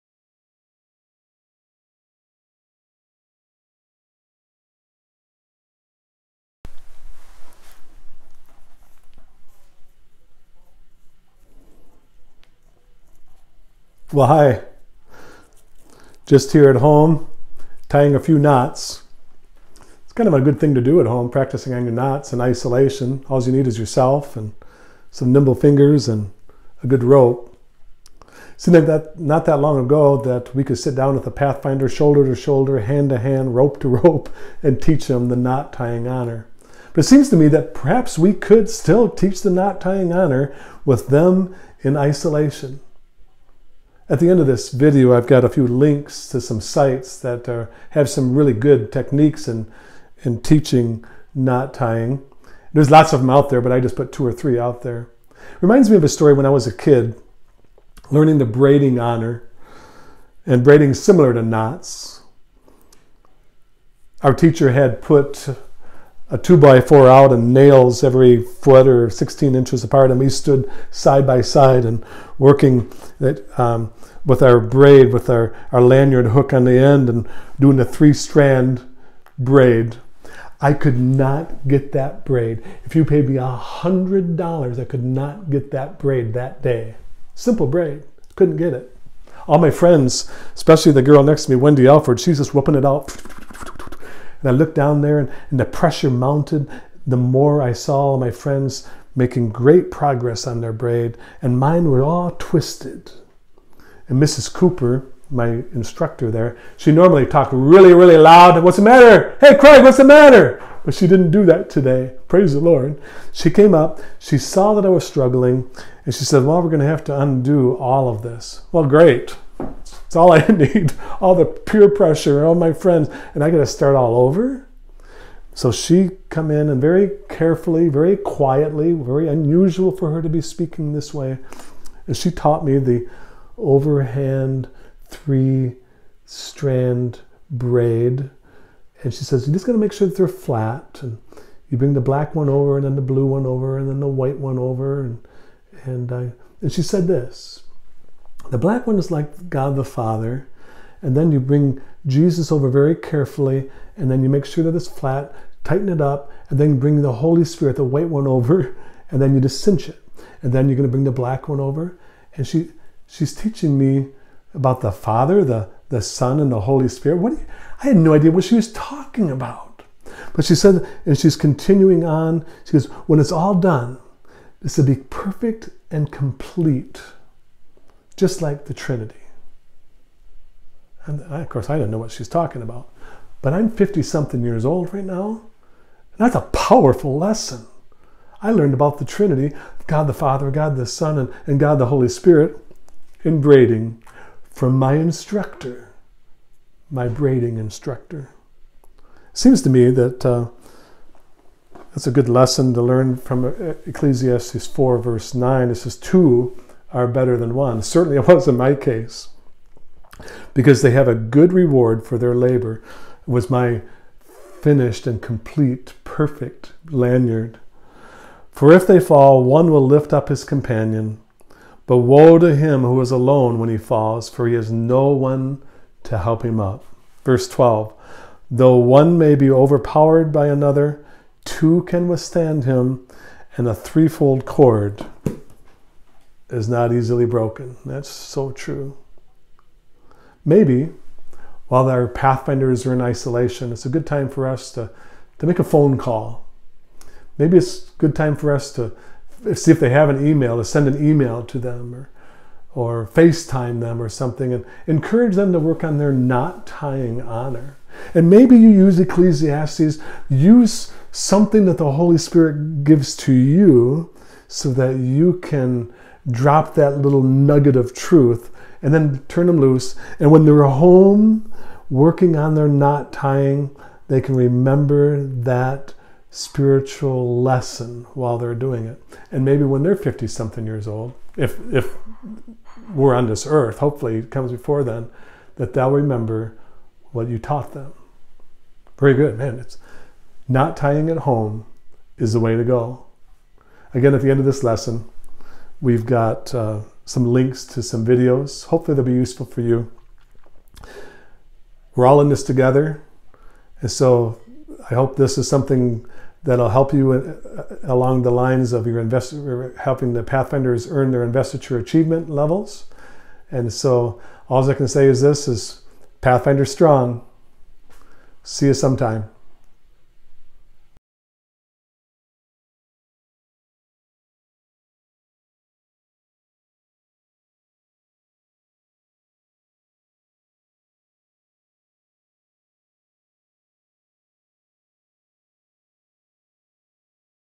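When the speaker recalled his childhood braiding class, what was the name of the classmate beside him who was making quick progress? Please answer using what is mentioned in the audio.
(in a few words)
Wendy Alford.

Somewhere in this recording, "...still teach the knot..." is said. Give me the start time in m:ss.
0:38.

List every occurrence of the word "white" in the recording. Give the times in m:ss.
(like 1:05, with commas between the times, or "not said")
2:24, 2:37.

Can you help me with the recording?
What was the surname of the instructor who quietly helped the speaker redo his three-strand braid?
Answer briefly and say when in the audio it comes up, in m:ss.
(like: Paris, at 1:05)
Cooper, at 1:44.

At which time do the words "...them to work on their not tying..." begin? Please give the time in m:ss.
4:15.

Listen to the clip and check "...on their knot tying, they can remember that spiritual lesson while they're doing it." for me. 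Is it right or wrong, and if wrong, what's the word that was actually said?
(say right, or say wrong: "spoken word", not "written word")
right.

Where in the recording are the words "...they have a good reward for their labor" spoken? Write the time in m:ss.
3:30.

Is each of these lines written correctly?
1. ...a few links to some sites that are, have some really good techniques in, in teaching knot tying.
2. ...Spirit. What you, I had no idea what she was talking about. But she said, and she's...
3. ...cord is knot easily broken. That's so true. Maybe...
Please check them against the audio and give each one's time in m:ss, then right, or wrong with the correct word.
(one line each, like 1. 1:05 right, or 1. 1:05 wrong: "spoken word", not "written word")
1. 0:45 right
2. 2:46 right
3. 3:54 right.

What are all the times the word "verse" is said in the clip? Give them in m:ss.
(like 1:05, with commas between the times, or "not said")
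3:24, 3:47.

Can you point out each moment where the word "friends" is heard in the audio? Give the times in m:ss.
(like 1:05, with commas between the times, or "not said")
1:29, 1:38, 2:02.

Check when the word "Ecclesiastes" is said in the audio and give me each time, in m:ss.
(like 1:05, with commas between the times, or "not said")
3:23, 4:18.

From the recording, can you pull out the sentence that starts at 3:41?
But woe to him who is alone when he falls, for he has no one to help him up.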